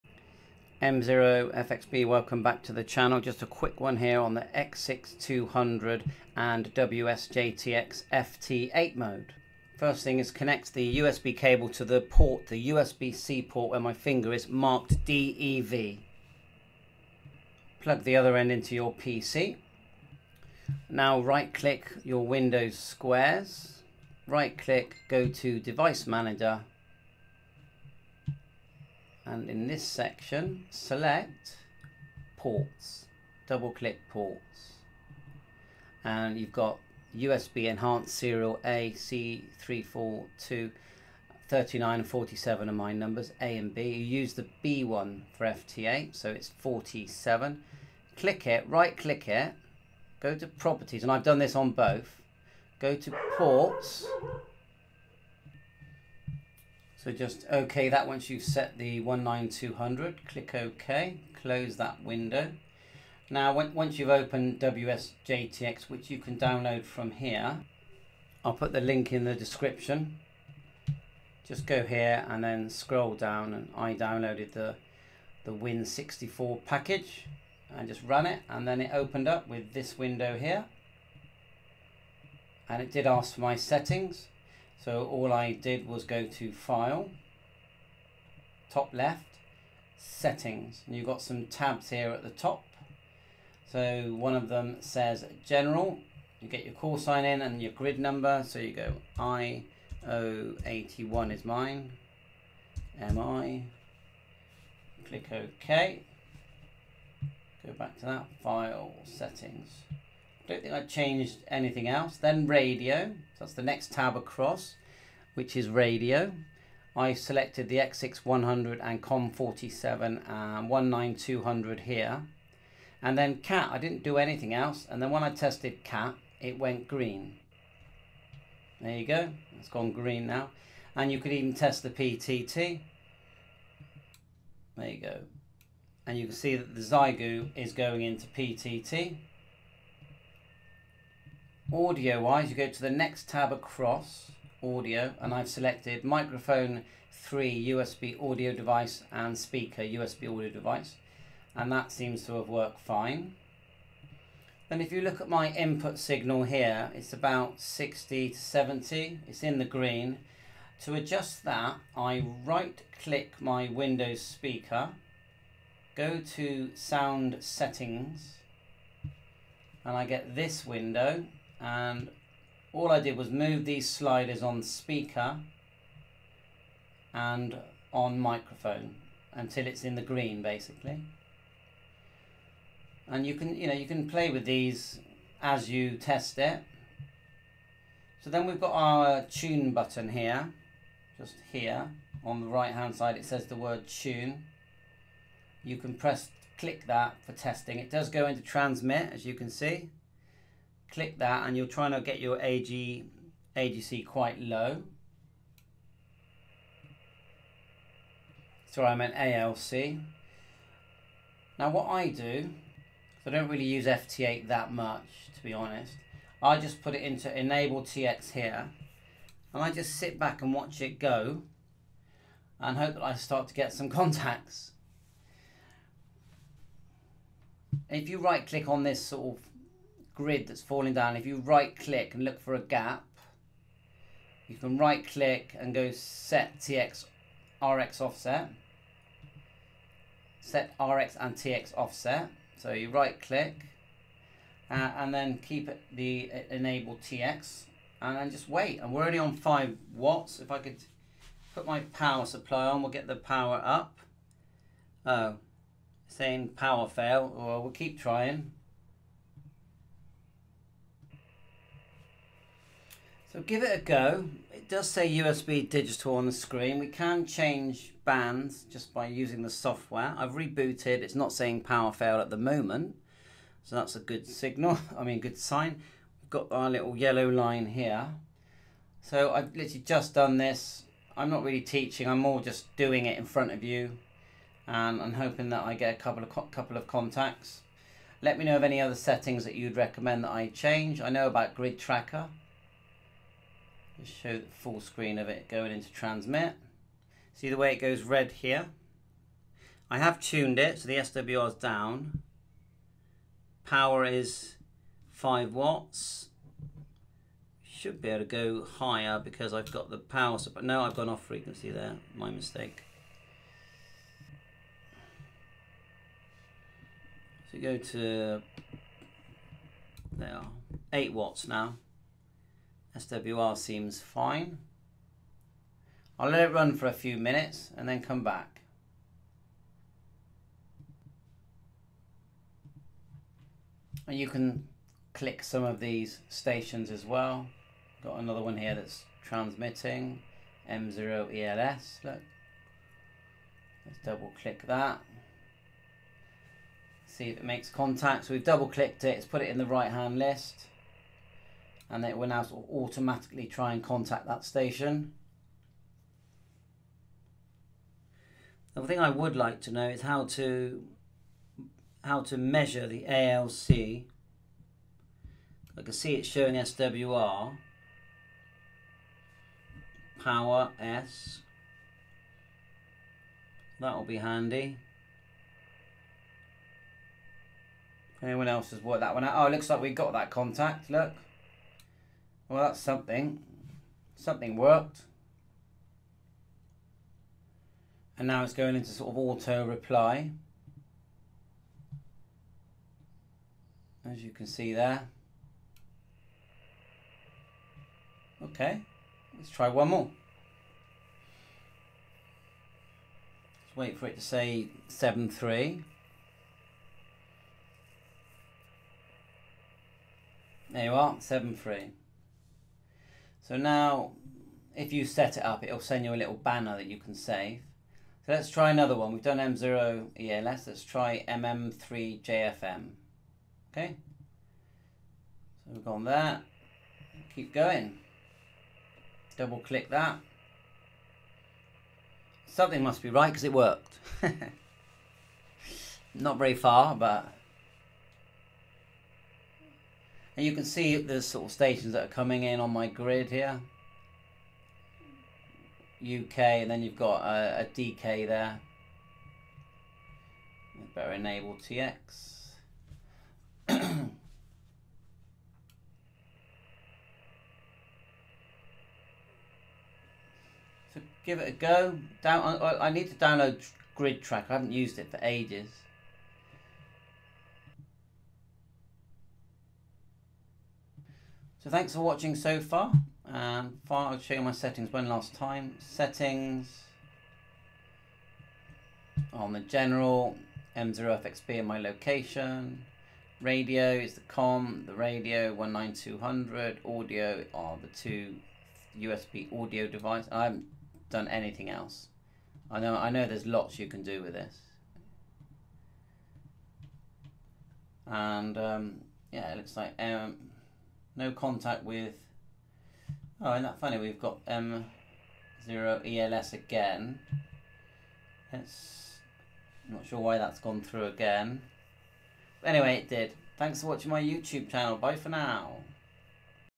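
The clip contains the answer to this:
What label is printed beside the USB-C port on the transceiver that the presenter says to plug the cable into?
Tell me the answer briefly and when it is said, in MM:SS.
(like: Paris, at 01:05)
DEV, at 00:15.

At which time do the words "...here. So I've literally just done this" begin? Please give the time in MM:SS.
04:37.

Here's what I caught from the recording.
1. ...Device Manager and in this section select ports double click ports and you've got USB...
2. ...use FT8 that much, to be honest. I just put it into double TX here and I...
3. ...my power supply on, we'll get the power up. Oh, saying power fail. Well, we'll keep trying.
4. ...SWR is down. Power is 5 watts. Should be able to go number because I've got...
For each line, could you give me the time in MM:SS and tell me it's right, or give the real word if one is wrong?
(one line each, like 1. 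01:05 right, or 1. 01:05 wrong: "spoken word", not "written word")
1. 00:25 right
2. 03:33 wrong: "enable", not "double"
3. 04:11 right
4. 05:00 wrong: "higher", not "number".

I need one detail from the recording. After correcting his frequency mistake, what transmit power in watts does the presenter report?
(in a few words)
8 watts.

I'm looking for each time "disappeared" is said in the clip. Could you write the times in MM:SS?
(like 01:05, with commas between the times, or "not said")
not said.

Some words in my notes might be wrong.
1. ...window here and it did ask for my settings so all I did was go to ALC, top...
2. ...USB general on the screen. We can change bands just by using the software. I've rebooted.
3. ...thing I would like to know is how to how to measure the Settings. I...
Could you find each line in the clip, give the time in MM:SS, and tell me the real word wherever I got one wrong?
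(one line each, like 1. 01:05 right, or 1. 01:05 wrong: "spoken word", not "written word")
1. 01:19 wrong: "File", not "ALC"
2. 04:25 wrong: "digital", not "general"
3. 05:58 wrong: "ALC", not "Settings".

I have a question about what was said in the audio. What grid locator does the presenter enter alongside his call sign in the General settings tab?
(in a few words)
IO81.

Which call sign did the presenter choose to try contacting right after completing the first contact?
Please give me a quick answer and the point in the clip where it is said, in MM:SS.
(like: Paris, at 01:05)
MM3JFM, at 07:01.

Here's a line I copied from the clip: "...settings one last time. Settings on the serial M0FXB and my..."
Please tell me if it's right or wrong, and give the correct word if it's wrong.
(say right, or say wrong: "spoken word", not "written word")
wrong: "general", not "serial".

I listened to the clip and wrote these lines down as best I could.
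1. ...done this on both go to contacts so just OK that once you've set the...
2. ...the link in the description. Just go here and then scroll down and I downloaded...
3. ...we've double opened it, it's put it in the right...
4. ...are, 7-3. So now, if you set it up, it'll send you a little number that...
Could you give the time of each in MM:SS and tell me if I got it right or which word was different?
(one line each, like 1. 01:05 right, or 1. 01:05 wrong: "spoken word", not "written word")
1. 00:51 wrong: "ports", not "contacts"
2. 01:08 right
3. 05:48 wrong: "clicked", not "opened"
4. 06:50 wrong: "banner", not "number".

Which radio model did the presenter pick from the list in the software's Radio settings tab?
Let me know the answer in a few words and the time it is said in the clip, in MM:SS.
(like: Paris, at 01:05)
X6100, at 01:57.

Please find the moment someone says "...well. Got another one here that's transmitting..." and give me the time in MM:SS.
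05:37.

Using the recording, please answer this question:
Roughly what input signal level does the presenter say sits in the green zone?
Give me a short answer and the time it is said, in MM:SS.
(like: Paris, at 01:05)
60 to 70, at 02:37.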